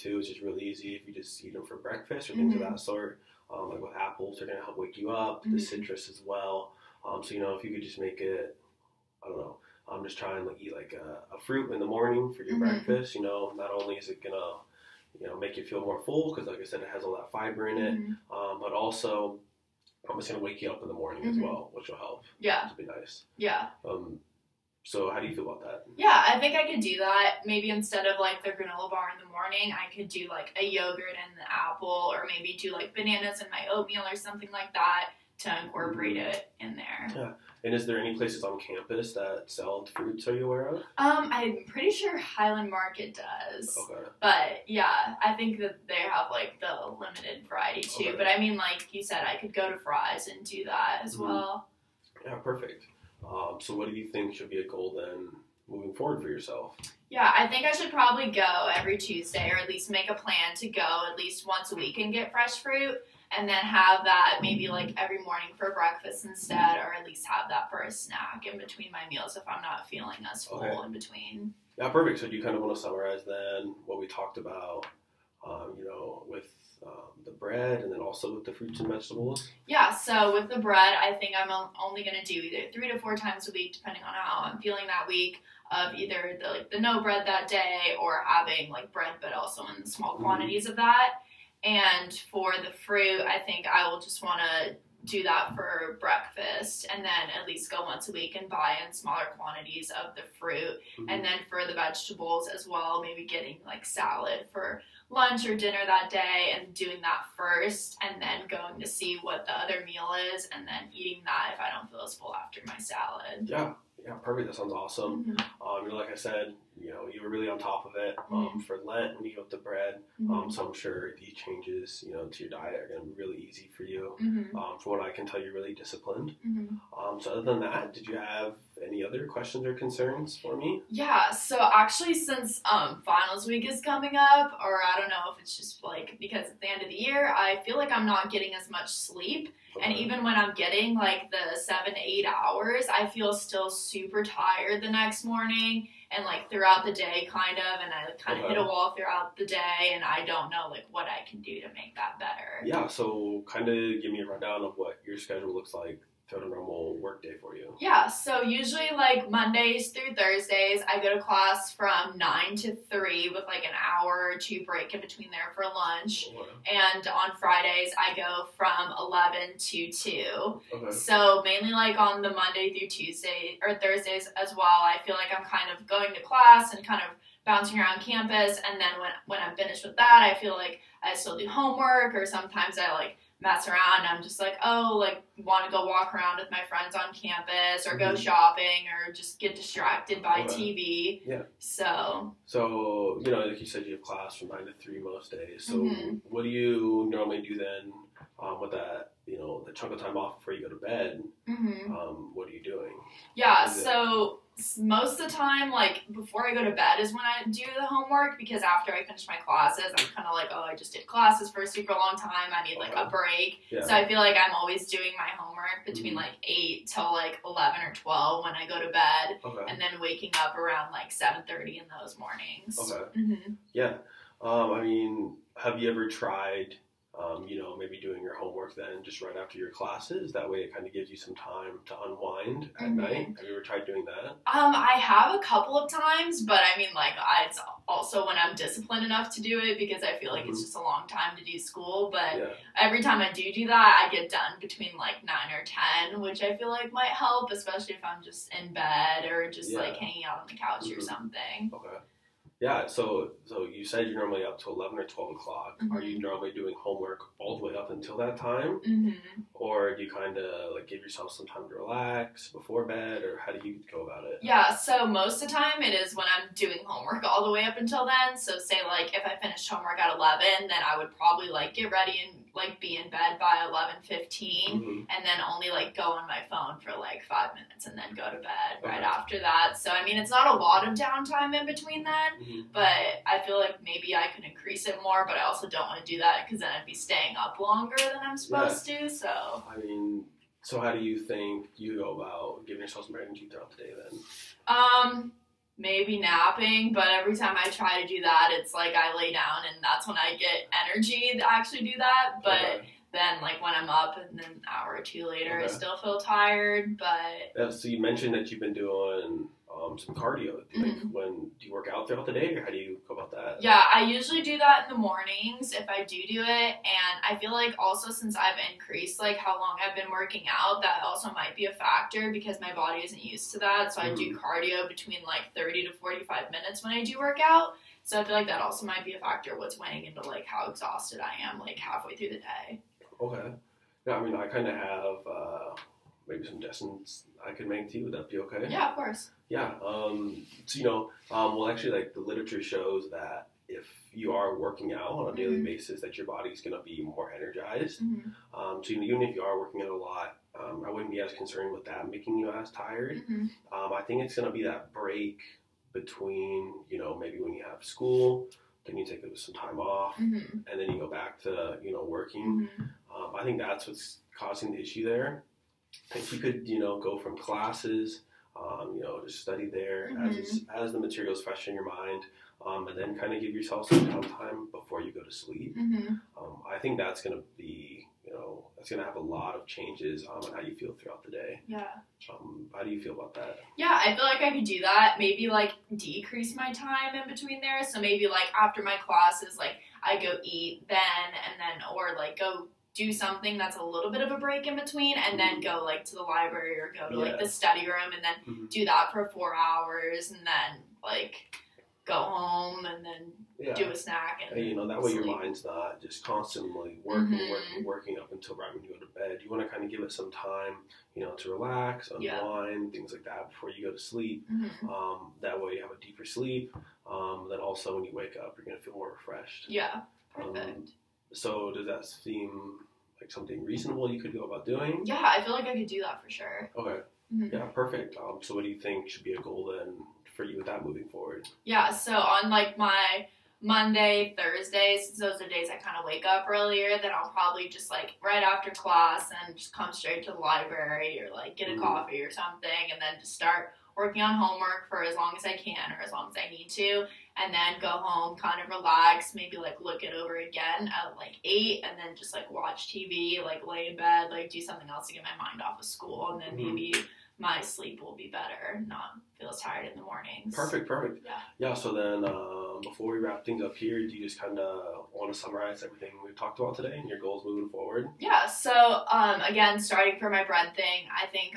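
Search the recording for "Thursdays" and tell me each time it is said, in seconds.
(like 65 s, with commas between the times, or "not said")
160 s, 173 s, 434 s.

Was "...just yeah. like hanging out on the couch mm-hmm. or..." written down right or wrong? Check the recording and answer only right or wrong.
right.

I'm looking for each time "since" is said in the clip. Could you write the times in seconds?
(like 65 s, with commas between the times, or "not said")
132 s, 318 s, 435 s.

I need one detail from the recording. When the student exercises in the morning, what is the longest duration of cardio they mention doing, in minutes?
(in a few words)
45.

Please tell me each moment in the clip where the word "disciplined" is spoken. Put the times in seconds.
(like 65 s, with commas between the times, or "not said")
125 s, 238 s.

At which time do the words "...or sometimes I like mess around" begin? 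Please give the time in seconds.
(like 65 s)
182 s.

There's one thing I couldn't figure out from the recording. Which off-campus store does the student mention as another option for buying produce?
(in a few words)
Fry's.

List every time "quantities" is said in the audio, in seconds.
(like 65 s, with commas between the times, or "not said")
90 s, 99 s.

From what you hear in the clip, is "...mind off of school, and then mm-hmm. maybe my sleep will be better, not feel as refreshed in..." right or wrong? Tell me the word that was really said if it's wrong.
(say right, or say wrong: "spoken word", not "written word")
wrong: "tired", not "refreshed".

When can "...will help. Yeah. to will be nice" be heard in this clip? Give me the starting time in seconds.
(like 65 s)
21 s.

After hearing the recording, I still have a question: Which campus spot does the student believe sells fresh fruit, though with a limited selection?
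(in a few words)
Highland Market.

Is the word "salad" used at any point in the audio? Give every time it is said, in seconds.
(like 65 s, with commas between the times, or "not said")
103 s, 112 s.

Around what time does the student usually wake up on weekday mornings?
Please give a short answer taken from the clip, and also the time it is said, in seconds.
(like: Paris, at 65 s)
7:30, at 221 s.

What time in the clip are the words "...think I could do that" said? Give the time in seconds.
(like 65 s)
26 s.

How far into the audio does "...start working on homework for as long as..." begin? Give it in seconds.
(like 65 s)
443 s.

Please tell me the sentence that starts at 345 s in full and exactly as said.
basis, that your body's going to be more energized.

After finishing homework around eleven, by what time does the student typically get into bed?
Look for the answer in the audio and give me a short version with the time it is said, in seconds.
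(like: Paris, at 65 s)
11:15, at 273 s.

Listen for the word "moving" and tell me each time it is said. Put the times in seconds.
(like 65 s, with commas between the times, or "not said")
55 s, 430 s, 467 s.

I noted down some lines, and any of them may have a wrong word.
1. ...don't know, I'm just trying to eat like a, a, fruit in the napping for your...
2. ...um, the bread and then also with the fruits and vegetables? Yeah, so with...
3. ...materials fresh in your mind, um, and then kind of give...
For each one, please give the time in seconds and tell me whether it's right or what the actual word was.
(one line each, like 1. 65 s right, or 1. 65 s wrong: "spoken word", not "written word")
1. 9 s wrong: "morning", not "napping"
2. 76 s right
3. 370 s right.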